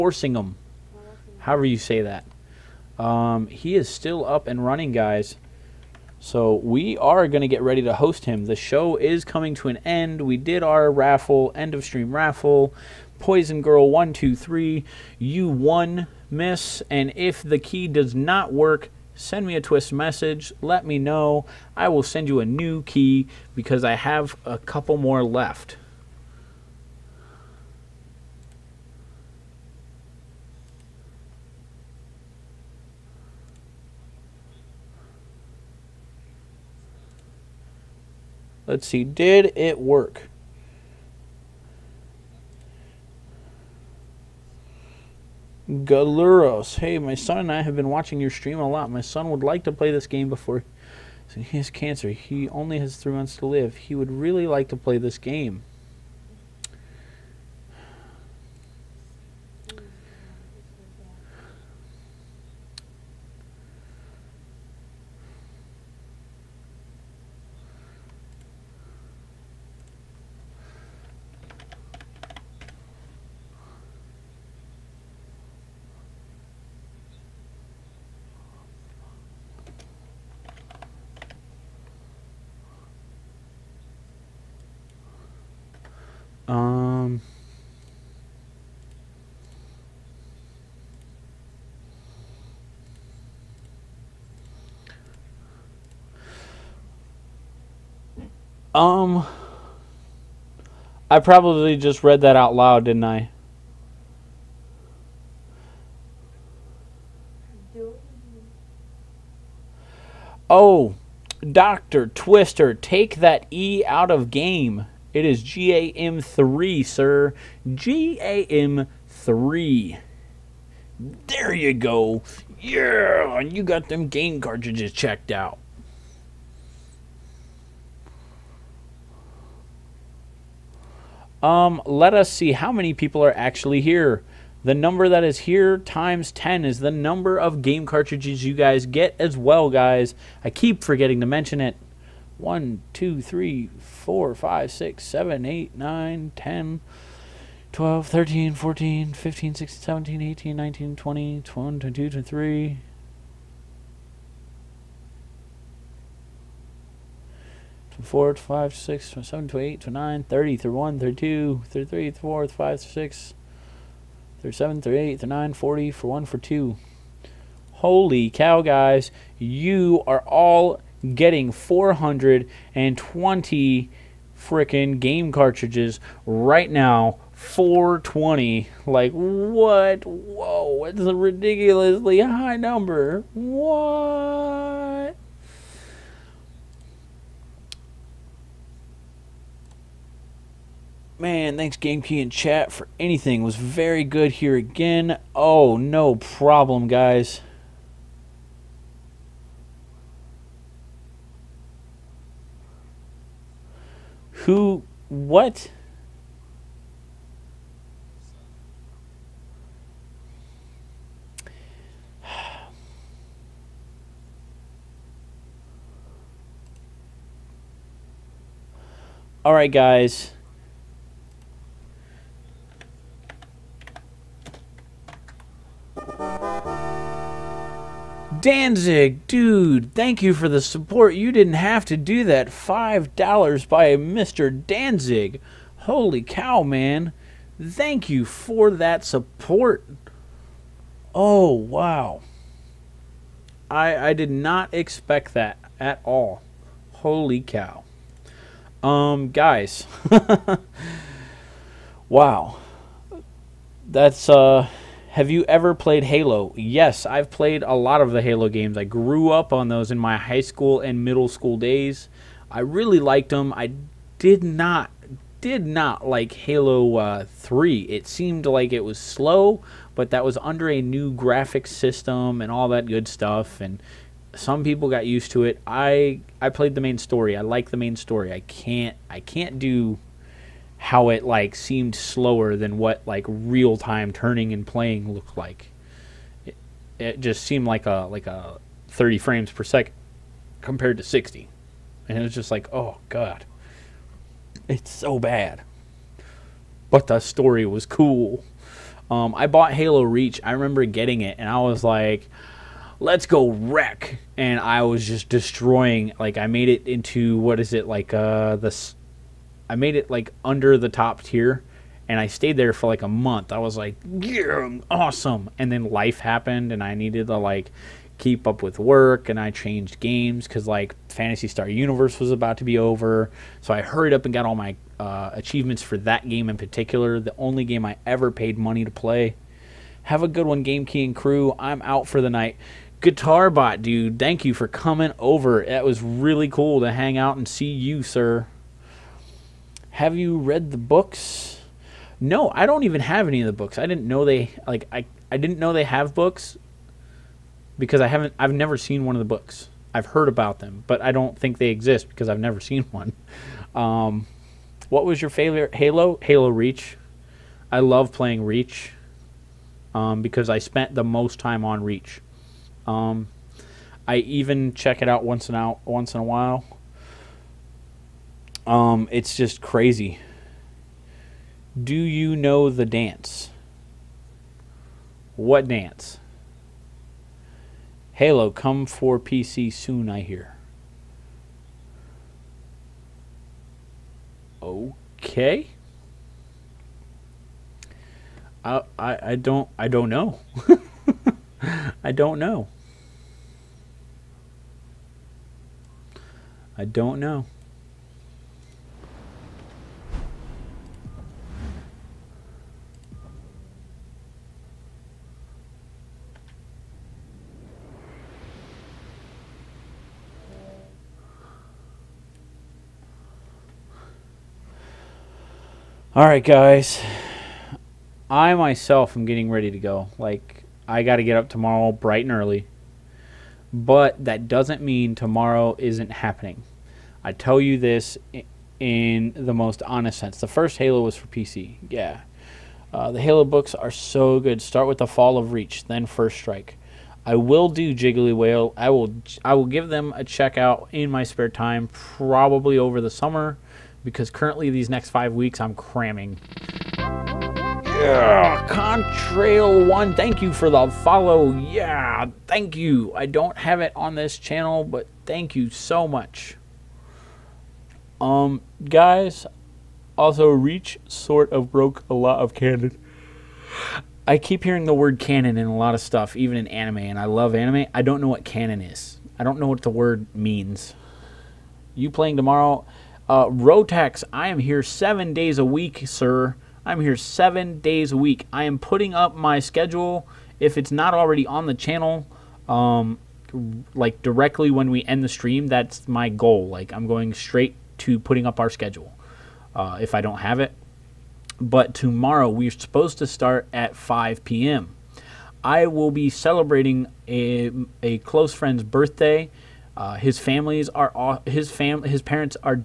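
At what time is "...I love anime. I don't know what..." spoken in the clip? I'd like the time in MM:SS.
07:47.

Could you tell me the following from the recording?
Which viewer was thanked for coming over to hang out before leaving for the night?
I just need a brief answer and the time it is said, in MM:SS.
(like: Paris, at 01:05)
Guitar Bot, at 05:33.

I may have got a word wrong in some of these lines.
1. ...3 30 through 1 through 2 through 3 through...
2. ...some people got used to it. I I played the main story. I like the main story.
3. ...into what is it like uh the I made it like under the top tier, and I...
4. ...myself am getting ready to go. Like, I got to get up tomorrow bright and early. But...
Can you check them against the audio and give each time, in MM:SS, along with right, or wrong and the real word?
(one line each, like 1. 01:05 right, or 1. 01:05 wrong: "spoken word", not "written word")
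1. 02:39 wrong: "9", not "3"
2. 04:34 right
3. 05:06 right
4. 06:58 right.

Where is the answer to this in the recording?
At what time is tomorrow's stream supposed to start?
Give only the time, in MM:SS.
08:13.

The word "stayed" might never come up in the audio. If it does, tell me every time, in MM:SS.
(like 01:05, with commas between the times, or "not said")
05:12.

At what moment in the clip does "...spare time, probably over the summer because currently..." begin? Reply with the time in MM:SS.
07:21.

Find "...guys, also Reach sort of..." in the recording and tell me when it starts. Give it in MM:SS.
07:38.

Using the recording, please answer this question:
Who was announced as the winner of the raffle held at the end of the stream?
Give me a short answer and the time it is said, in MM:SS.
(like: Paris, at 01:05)
Poison Girl 123, at 00:13.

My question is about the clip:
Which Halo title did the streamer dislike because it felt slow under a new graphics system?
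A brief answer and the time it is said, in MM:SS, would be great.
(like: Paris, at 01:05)
Halo 3, at 04:26.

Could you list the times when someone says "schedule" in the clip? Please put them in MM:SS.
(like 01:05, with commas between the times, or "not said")
07:59, 08:08.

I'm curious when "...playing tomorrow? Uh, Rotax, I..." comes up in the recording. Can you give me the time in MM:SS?
07:52.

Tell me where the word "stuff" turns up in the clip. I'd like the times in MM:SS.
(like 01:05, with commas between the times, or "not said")
04:33, 07:46.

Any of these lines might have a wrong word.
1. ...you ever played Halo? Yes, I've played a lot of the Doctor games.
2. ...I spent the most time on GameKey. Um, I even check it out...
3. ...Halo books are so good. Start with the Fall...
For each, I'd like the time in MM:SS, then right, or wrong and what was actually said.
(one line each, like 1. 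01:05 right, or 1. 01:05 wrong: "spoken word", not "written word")
1. 04:15 wrong: "Halo", not "Doctor"
2. 06:00 wrong: "Reach", not "GameKey"
3. 07:13 right.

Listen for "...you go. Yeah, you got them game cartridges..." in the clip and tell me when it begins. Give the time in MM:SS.
02:01.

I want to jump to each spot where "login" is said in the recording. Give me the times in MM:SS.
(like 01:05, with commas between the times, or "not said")
not said.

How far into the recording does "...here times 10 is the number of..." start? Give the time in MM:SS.
02:15.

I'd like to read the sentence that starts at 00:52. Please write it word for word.
He only has three months to live.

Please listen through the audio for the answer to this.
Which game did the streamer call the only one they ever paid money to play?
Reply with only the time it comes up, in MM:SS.
05:21.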